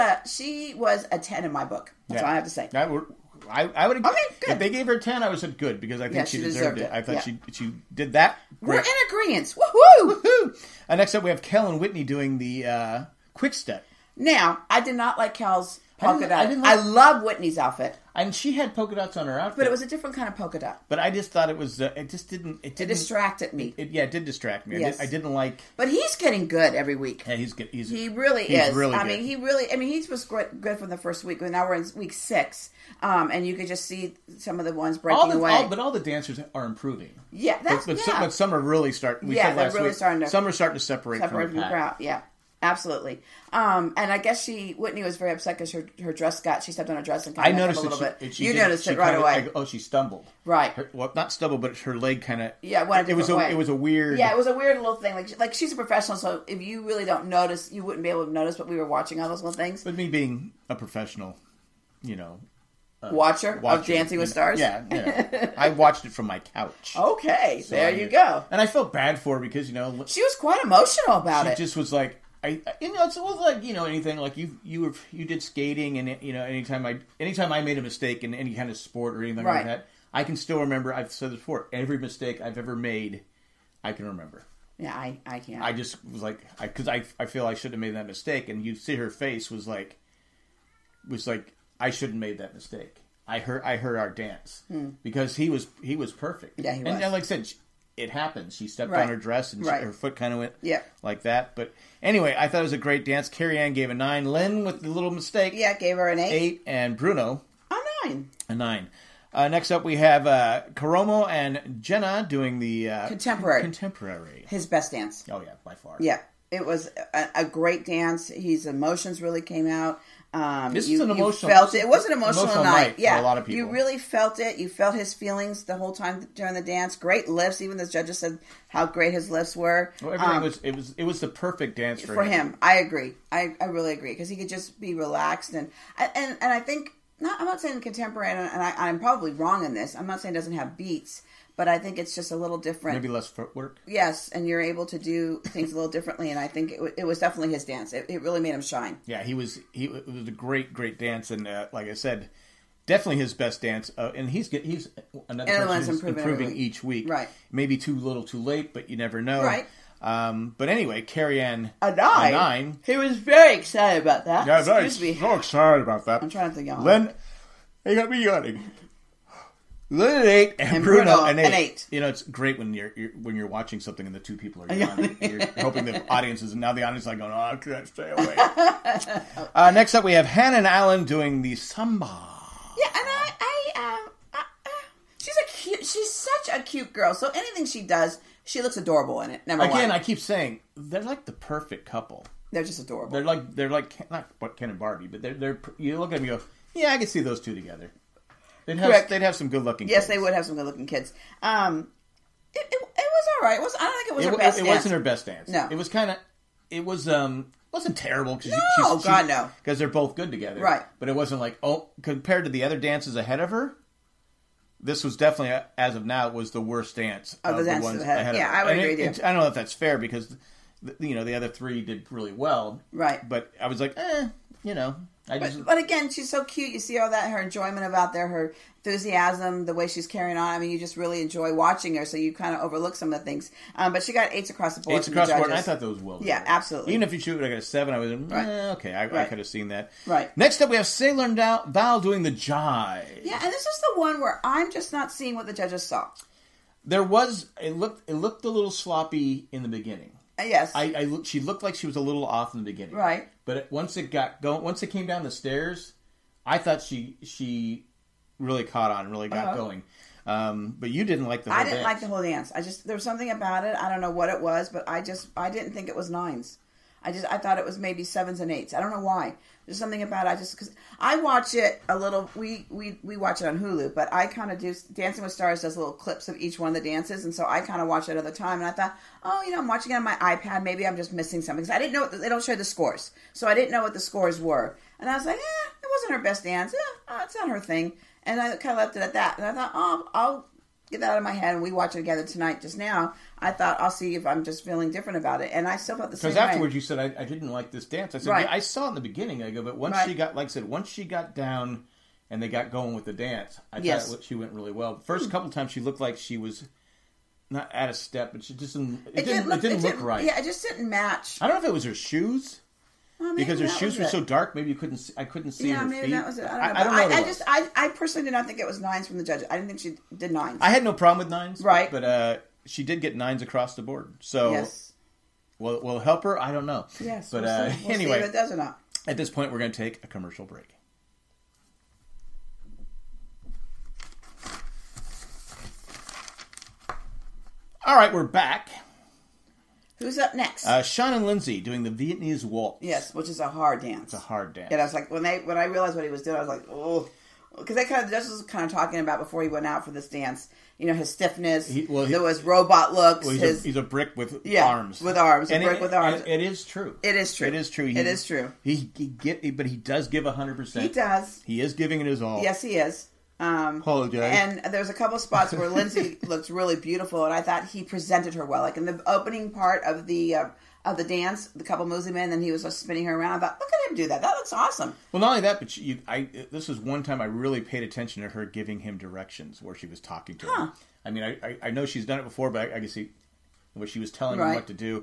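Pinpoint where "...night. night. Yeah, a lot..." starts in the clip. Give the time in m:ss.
2:02.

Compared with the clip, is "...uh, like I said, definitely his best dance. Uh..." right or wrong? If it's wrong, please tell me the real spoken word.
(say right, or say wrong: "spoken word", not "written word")
right.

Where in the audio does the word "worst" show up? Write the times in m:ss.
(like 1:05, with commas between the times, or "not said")
3:36.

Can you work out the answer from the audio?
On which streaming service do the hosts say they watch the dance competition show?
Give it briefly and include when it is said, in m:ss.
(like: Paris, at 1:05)
Hulu, at 4:33.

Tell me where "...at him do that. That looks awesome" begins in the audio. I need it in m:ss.
6:13.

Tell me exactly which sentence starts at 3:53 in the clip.
Um, but she got eights across the board.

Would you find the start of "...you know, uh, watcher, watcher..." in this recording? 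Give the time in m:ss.
1:02.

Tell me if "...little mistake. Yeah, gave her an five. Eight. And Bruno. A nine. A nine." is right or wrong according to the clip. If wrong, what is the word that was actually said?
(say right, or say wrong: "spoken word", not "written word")
wrong: "eight", not "five".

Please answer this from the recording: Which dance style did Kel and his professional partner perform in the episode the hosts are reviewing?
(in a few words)
Quick step.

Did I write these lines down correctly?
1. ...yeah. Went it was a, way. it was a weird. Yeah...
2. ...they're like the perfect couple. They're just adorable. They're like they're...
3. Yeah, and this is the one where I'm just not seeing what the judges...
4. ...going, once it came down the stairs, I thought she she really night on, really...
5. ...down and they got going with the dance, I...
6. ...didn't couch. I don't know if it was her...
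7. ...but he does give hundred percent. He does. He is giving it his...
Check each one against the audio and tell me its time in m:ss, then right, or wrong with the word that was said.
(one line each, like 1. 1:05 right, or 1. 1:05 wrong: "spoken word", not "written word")
1. 0:52 right
2. 3:10 right
3. 4:03 right
4. 4:14 wrong: "caught", not "night"
5. 5:01 right
6. 5:10 wrong: "match", not "couch"
7. 5:59 right.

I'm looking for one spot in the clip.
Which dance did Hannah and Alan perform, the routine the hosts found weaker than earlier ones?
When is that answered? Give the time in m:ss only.
3:01.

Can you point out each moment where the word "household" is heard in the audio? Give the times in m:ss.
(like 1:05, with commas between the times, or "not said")
not said.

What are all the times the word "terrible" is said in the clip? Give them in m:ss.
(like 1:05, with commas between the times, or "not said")
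3:27.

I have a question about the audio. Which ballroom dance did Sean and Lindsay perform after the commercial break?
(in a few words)
Viennese waltz.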